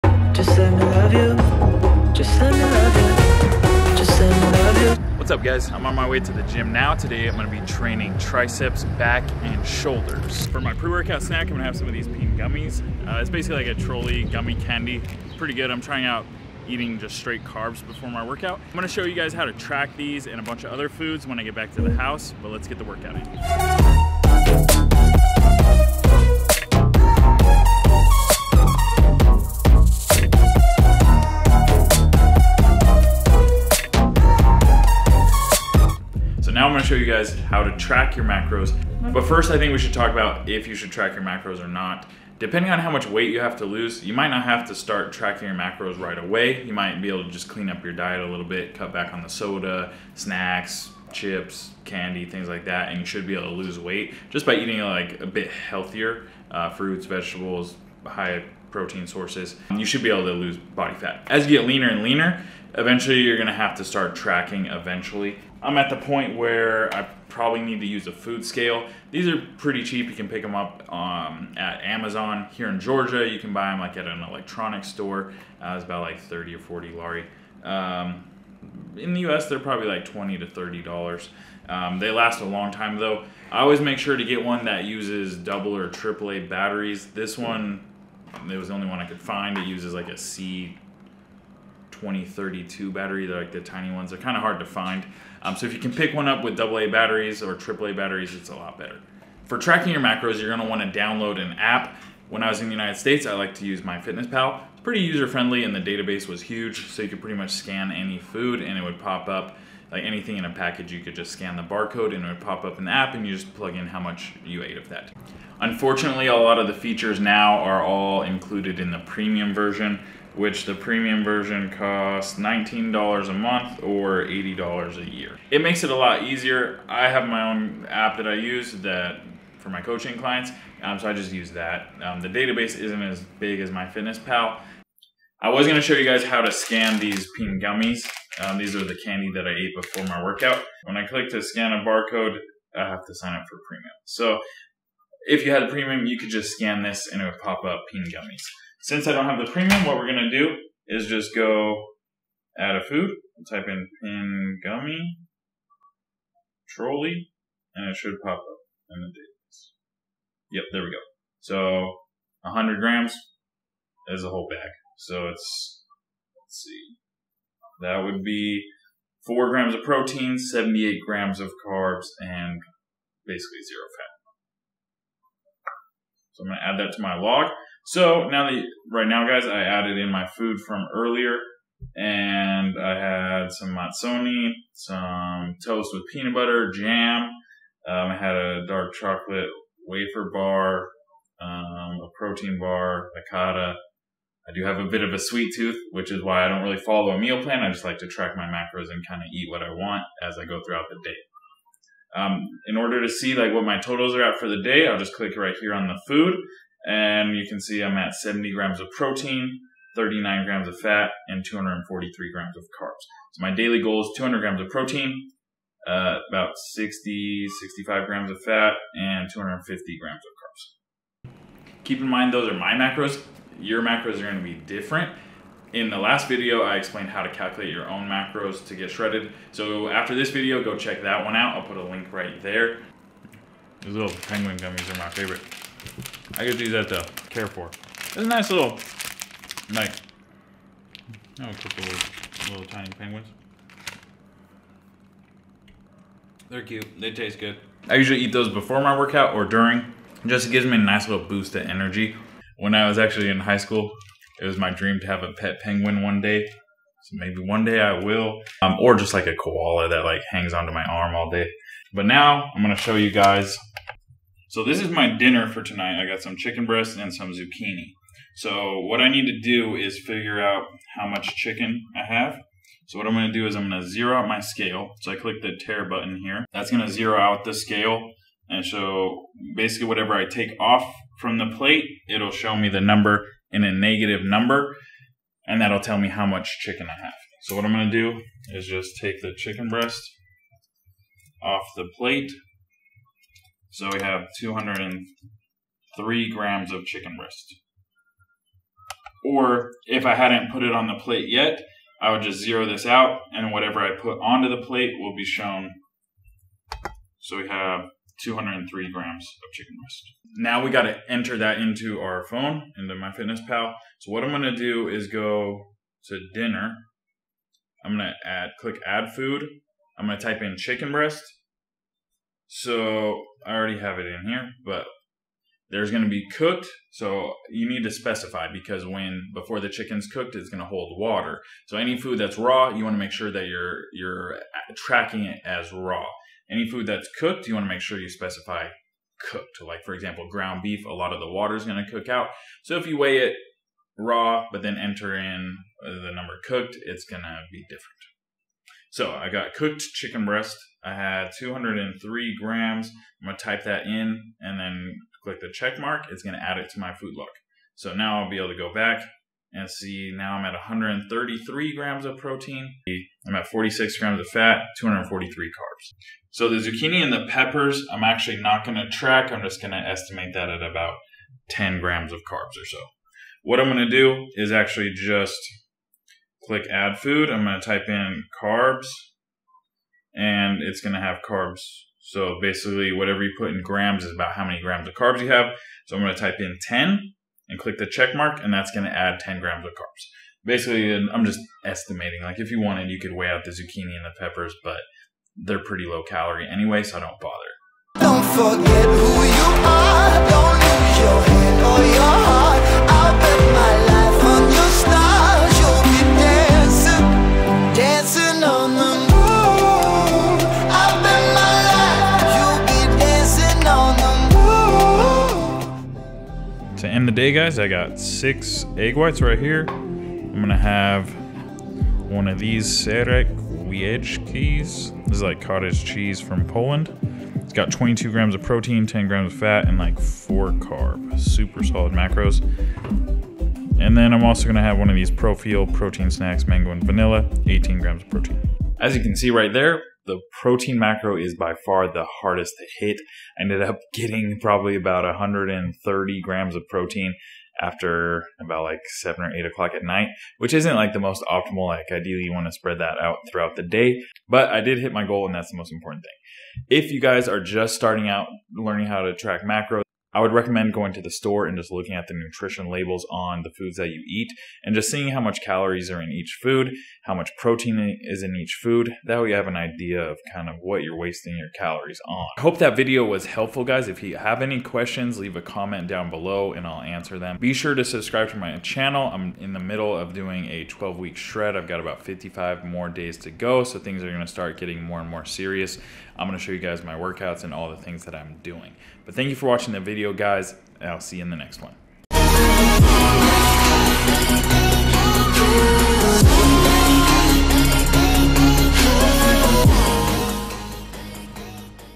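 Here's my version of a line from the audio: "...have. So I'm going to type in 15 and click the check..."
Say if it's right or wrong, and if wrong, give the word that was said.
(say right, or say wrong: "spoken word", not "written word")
wrong: "10", not "15".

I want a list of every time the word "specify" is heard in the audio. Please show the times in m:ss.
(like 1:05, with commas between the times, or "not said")
5:27, 5:38.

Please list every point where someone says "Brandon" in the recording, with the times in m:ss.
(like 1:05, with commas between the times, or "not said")
not said.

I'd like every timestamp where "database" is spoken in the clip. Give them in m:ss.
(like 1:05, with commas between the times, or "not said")
1:45, 2:12, 2:39.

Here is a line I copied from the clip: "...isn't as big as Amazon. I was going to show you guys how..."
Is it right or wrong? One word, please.
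wrong.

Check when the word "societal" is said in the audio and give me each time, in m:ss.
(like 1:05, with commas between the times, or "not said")
not said.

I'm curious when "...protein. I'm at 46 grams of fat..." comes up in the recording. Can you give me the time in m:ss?
6:02.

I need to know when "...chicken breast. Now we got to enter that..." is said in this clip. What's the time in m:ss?
5:09.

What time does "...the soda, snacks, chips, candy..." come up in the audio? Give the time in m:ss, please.
0:49.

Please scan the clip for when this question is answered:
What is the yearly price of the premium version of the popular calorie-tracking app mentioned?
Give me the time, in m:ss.
2:04.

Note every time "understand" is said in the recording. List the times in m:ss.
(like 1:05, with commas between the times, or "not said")
not said.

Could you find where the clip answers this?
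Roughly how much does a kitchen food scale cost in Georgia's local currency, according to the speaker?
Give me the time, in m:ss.
1:16.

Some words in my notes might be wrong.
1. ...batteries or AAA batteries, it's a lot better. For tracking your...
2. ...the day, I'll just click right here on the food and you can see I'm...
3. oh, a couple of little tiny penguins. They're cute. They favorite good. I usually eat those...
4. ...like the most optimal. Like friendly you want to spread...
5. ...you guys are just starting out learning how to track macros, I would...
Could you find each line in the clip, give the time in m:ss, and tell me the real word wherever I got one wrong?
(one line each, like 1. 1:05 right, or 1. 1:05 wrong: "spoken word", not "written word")
1. 1:36 right
2. 3:24 right
3. 4:01 wrong: "taste", not "favorite"
4. 7:30 wrong: "ideally", not "friendly"
5. 7:36 right.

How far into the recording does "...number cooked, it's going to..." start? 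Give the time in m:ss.
5:46.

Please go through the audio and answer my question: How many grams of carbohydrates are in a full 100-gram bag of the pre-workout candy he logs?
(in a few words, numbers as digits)
78.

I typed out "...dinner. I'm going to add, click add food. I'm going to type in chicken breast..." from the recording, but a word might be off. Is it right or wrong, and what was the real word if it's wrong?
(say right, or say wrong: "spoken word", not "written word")
right.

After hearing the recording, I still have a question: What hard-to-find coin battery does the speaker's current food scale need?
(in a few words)
C 2032.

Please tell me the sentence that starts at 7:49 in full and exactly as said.
That way you have an idea of kind of what you're wasting your calories on.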